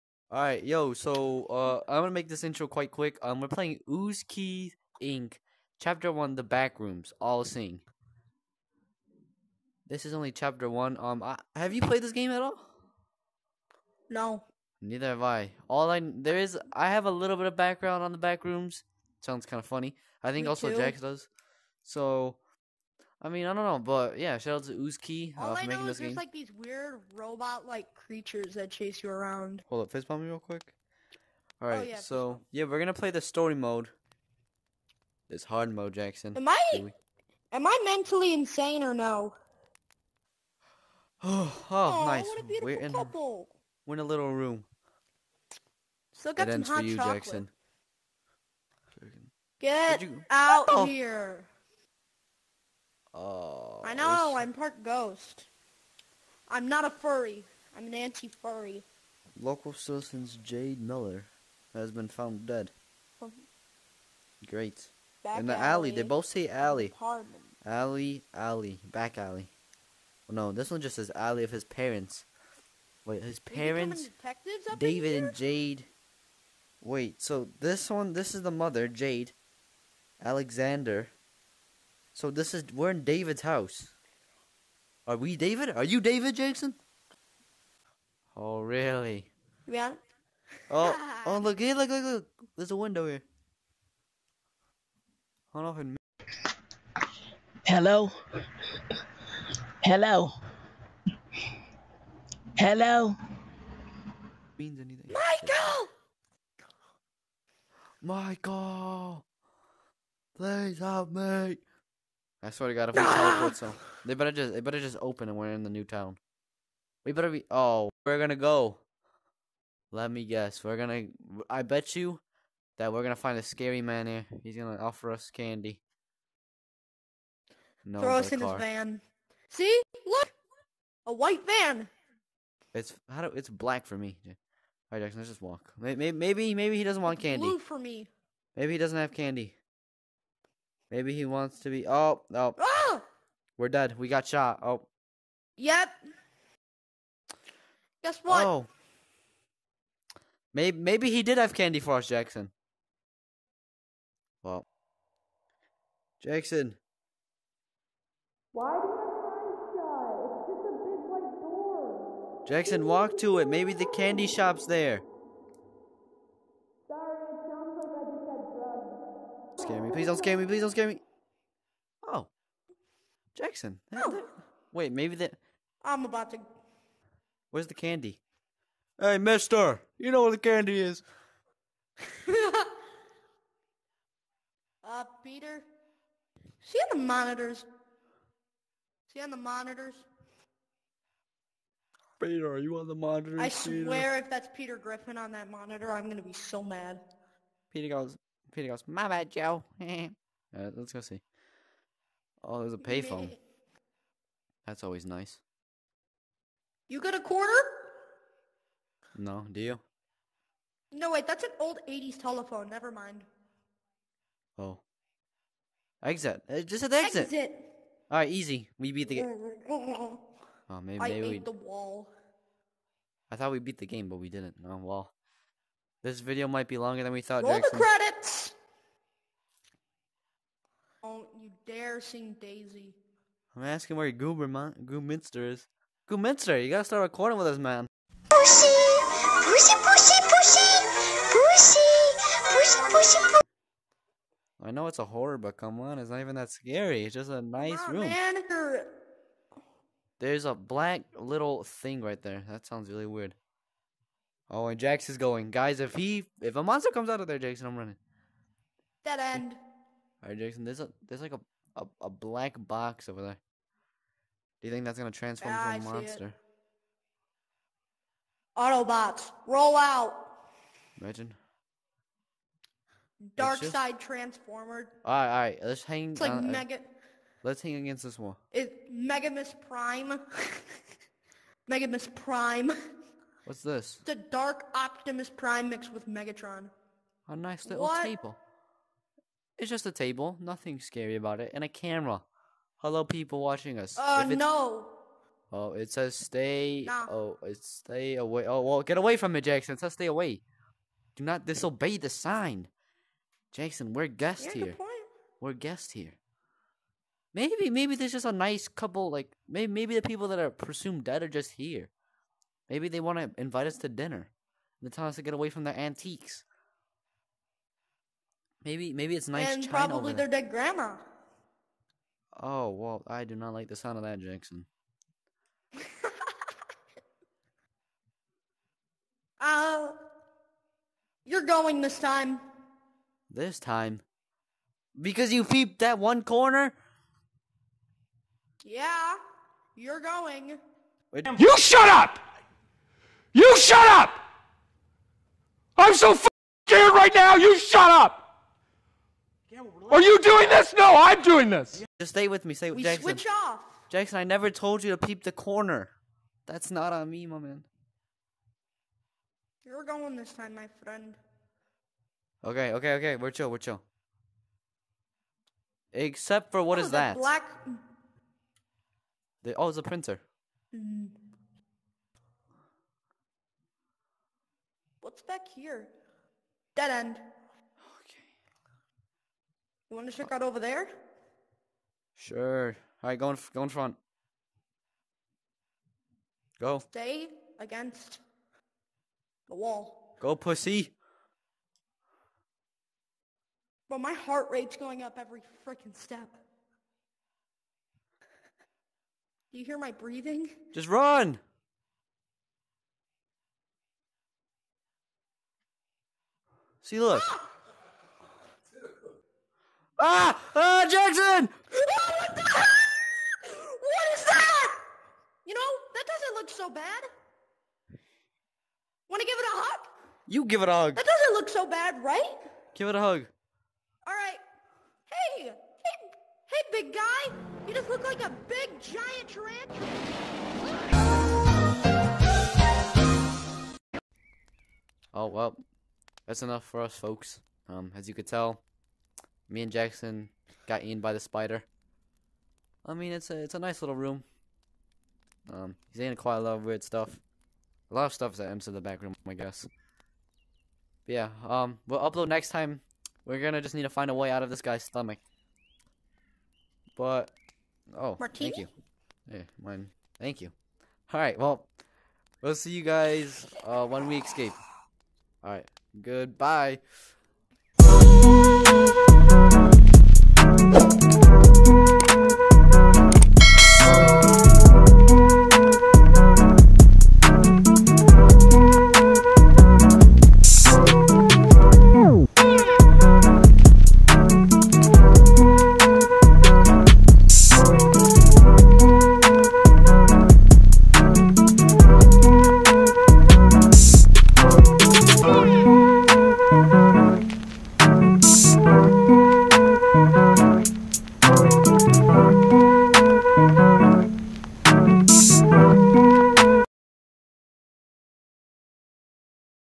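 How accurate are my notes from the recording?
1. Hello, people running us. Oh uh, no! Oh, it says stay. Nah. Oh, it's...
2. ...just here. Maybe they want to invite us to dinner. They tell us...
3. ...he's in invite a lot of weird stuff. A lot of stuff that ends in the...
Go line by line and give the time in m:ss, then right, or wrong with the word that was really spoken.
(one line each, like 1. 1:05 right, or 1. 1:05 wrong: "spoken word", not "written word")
1. 4:52 wrong: "watching", not "running"
2. 5:11 right
3. 7:25 wrong: "quite", not "invite".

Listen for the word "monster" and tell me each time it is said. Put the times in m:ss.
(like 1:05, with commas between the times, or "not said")
4:16, 4:25.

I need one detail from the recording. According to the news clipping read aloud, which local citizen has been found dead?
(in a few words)
Jade Miller.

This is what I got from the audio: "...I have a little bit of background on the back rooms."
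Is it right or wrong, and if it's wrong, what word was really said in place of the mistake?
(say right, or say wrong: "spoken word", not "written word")
right.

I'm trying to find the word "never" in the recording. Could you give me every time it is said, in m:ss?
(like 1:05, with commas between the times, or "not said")
3:32, 5:54.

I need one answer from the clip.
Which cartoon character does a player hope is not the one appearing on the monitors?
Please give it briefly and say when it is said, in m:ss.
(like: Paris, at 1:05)
Peter Griffin, at 3:14.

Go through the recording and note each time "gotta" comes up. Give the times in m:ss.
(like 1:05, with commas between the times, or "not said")
3:56.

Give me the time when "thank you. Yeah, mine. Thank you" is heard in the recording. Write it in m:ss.
7:38.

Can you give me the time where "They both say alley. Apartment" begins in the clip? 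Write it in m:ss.
1:05.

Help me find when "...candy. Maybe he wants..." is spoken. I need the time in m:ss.
2:19.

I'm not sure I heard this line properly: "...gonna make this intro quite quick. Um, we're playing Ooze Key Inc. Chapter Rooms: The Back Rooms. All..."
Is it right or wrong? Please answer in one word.
wrong.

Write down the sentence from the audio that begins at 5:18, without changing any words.
Maybe maybe it's nice and China probably their dead grandma.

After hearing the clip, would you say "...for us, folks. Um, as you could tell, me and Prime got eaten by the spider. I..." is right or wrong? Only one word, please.
wrong.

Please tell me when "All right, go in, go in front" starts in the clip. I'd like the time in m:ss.
6:23.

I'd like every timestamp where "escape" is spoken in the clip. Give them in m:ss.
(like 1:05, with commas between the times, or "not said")
7:44.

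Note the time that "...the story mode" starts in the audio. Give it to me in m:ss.
0:33.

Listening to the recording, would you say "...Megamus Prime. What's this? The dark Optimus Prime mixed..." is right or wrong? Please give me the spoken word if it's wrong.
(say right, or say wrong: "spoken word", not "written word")
right.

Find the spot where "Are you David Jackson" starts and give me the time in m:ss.
1:25.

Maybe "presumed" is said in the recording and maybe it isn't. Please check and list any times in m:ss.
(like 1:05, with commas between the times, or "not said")
5:10.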